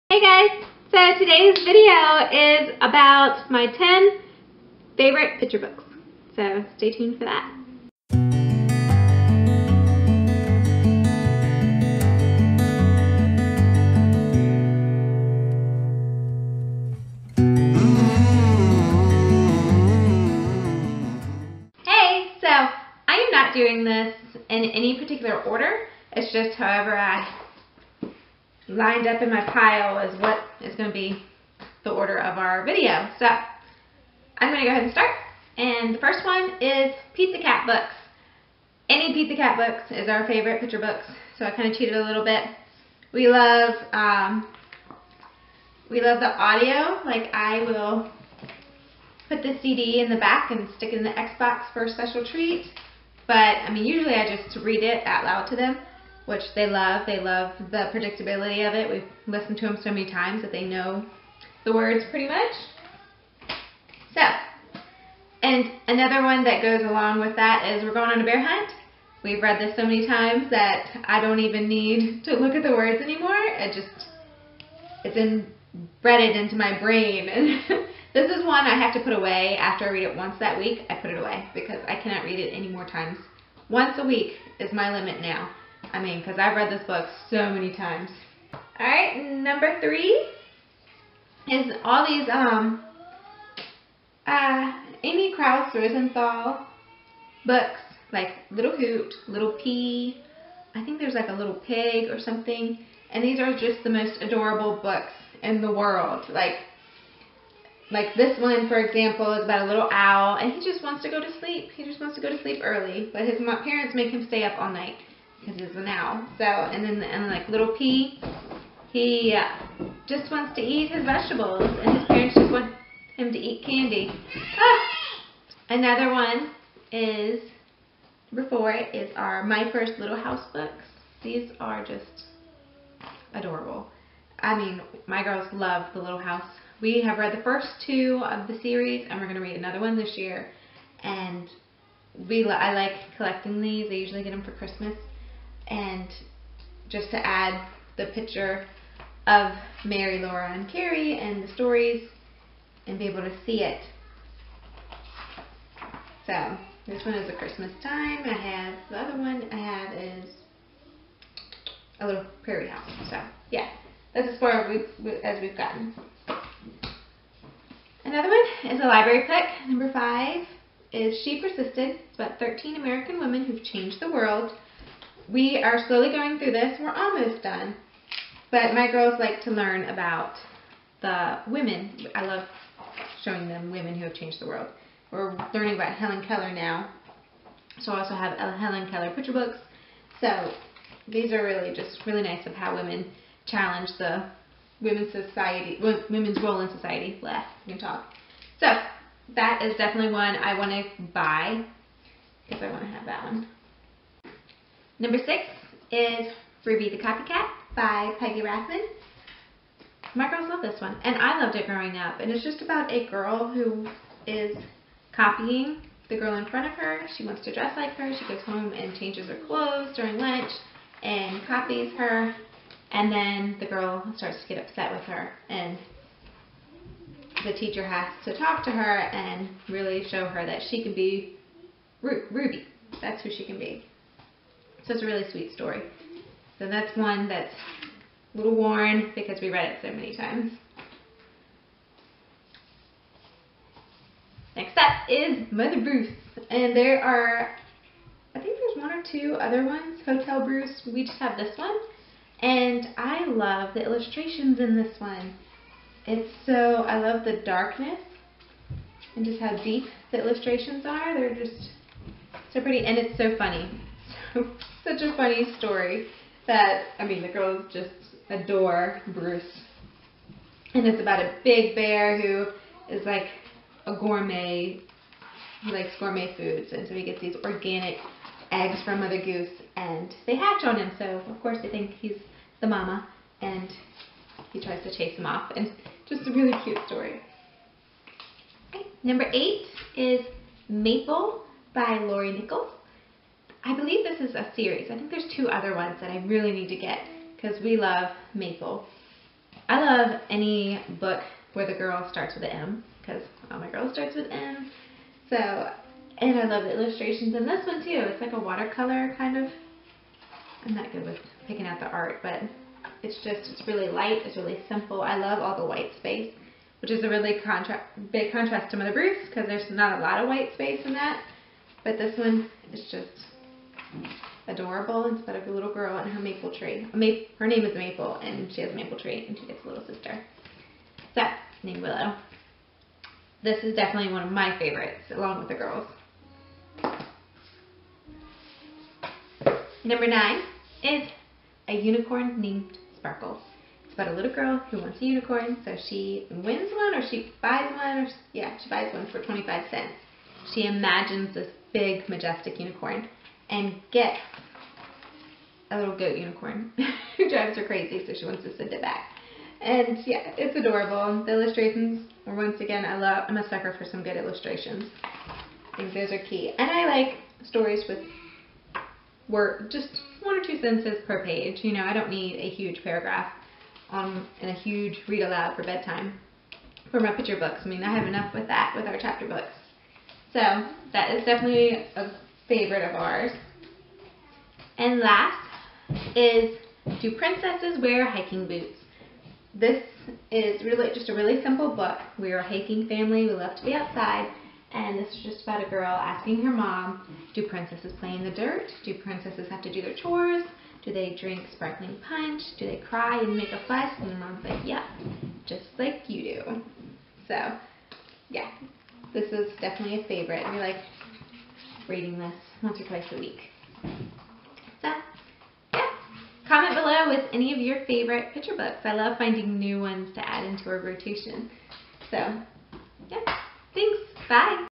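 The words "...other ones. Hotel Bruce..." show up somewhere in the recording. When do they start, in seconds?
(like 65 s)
249 s.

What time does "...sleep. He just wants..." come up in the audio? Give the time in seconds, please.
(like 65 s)
111 s.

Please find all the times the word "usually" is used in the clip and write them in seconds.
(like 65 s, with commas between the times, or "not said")
53 s, 143 s.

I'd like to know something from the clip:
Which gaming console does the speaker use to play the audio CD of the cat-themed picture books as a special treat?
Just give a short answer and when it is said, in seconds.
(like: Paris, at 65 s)
Xbox, at 51 s.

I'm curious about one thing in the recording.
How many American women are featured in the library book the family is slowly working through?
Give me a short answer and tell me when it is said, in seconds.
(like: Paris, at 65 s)
13, at 172 s.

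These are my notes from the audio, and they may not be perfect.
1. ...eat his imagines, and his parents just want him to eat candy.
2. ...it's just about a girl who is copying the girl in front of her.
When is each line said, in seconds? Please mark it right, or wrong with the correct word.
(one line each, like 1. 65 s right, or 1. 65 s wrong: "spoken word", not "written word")
1. 120 s wrong: "vegetables", not "imagines"
2. 212 s right.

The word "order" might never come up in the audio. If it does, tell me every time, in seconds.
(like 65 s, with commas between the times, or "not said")
25 s, 31 s.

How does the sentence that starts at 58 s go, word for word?
We've listened to them so many times that they know the words pretty much.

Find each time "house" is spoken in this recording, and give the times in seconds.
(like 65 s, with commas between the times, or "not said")
130 s, 136 s, 162 s.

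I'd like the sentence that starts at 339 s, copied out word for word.
Number nine is a unicorn named Sparkle.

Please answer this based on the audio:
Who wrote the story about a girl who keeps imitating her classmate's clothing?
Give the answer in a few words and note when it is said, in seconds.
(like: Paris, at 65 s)
Peggy Rathmann, at 208 s.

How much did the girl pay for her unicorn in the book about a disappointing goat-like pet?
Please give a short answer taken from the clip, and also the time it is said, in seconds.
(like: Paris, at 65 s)
25 cents, at 349 s.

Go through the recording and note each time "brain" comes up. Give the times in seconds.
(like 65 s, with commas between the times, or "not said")
76 s.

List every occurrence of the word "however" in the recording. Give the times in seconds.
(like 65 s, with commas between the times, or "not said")
26 s.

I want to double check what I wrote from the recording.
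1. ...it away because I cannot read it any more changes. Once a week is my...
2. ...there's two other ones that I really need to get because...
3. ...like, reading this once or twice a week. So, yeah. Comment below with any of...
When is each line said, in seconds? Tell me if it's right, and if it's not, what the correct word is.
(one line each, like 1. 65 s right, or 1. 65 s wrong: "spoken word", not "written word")
1. 81 s wrong: "times", not "changes"
2. 295 s right
3. 410 s right.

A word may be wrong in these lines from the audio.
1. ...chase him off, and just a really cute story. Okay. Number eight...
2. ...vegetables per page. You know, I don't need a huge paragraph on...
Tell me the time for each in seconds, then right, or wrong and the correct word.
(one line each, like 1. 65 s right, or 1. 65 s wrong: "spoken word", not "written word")
1. 284 s right
2. 370 s wrong: "sentences", not "vegetables".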